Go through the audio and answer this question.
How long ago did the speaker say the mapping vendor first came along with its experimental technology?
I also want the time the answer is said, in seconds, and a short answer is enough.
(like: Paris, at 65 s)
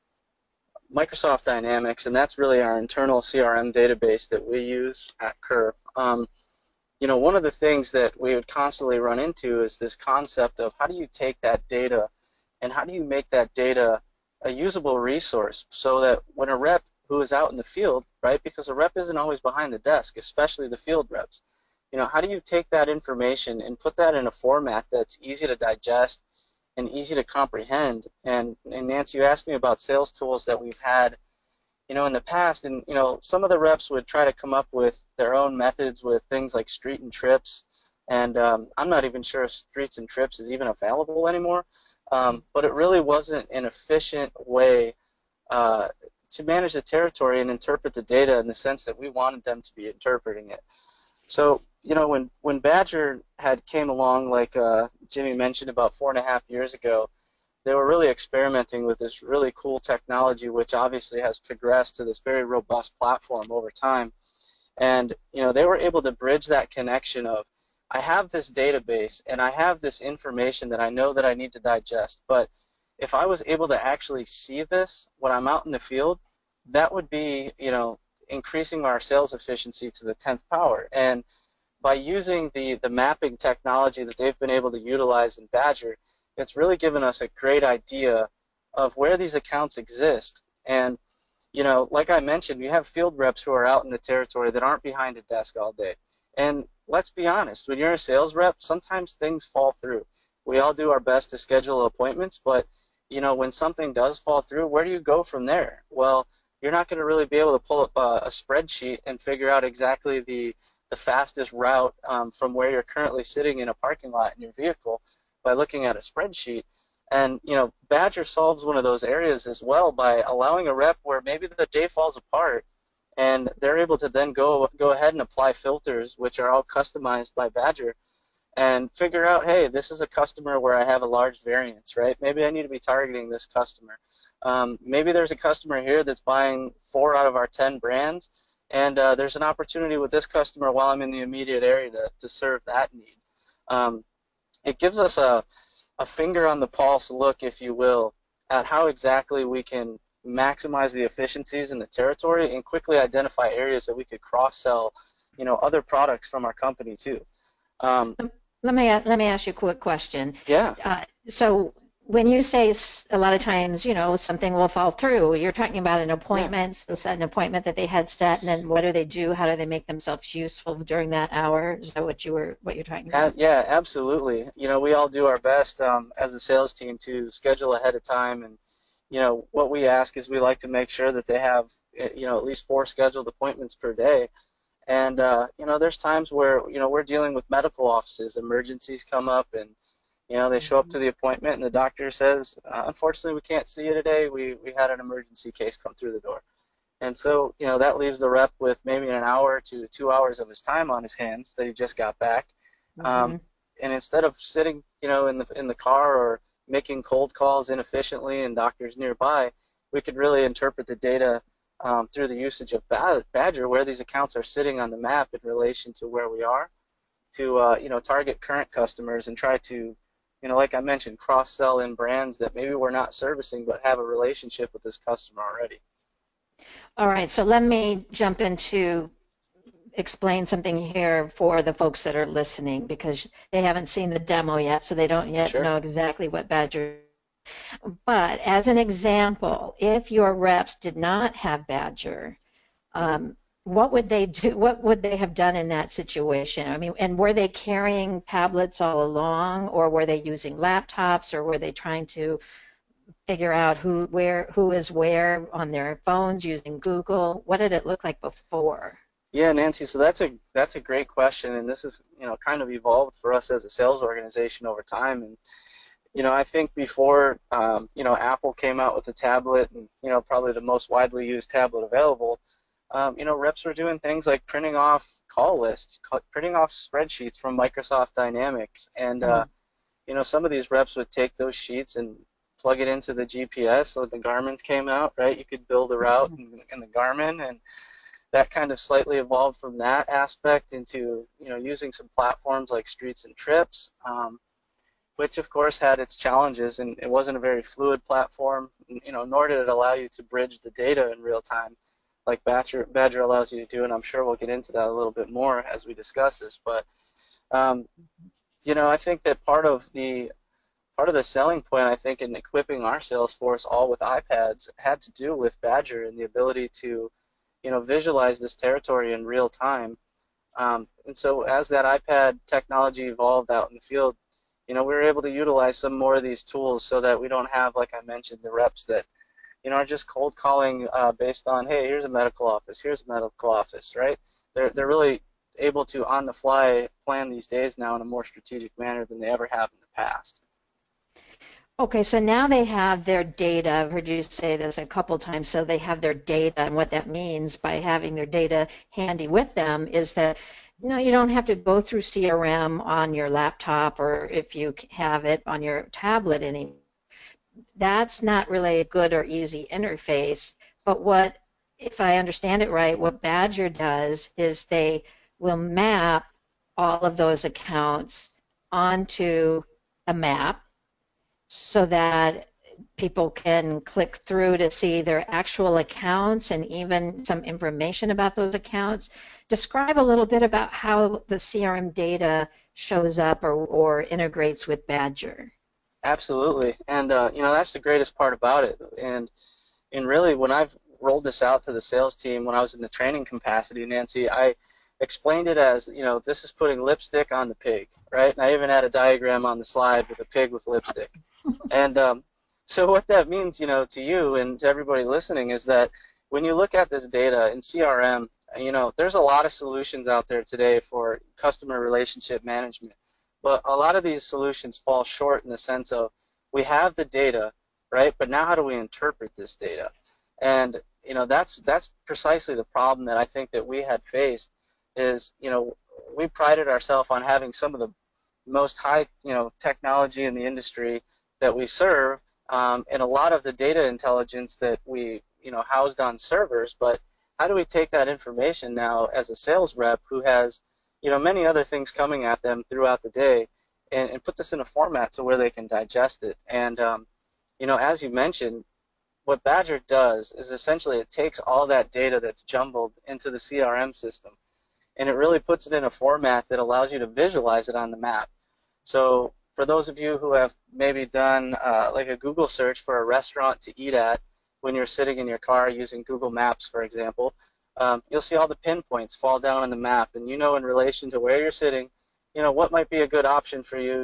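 4.5 years, at 55 s.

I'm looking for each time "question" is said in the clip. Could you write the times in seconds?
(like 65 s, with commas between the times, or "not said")
159 s, 261 s.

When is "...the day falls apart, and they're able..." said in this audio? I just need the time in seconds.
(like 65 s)
121 s.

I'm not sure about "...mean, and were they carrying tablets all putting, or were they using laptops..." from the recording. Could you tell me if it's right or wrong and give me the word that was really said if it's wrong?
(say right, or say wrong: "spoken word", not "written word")
wrong: "along", not "putting".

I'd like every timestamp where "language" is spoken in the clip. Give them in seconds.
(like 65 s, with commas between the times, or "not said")
not said.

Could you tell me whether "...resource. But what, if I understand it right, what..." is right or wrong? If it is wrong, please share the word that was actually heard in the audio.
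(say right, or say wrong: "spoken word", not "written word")
wrong: "interface", not "resource".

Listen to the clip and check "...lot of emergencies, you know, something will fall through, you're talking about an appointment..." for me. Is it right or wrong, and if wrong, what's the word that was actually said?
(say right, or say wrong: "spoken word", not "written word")
wrong: "times", not "emergencies".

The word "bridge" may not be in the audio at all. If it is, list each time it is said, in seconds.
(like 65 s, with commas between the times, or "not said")
66 s, 300 s.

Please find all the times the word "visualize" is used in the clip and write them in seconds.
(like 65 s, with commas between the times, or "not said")
317 s, 457 s.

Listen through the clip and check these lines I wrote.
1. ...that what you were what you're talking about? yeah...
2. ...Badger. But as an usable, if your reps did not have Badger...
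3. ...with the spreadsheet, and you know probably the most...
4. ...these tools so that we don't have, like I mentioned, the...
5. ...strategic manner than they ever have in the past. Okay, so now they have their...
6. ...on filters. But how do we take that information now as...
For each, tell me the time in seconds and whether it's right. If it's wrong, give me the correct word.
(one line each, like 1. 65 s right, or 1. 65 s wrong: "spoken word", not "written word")
1. 171 s right
2. 236 s wrong: "example", not "usable"
3. 268 s wrong: "tablet", not "spreadsheet"
4. 326 s right
5. 338 s right
6. 435 s wrong: "servers", not "filters".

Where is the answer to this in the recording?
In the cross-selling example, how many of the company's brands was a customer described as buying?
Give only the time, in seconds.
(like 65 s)
136 s.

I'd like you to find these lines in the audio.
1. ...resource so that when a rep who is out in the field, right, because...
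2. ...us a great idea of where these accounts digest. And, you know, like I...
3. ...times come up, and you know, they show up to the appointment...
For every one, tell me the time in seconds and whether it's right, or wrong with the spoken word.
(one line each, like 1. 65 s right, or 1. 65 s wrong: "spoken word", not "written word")
1. 14 s right
2. 87 s wrong: "exist", not "digest"
3. 188 s wrong: "emergencies", not "times".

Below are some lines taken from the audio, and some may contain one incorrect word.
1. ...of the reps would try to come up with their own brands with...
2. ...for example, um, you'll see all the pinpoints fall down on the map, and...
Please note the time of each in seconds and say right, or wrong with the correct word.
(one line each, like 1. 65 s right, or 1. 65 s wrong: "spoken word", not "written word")
1. 33 s wrong: "methods", not "brands"
2. 466 s right.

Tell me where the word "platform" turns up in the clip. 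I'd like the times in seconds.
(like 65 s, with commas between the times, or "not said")
62 s, 292 s, 298 s.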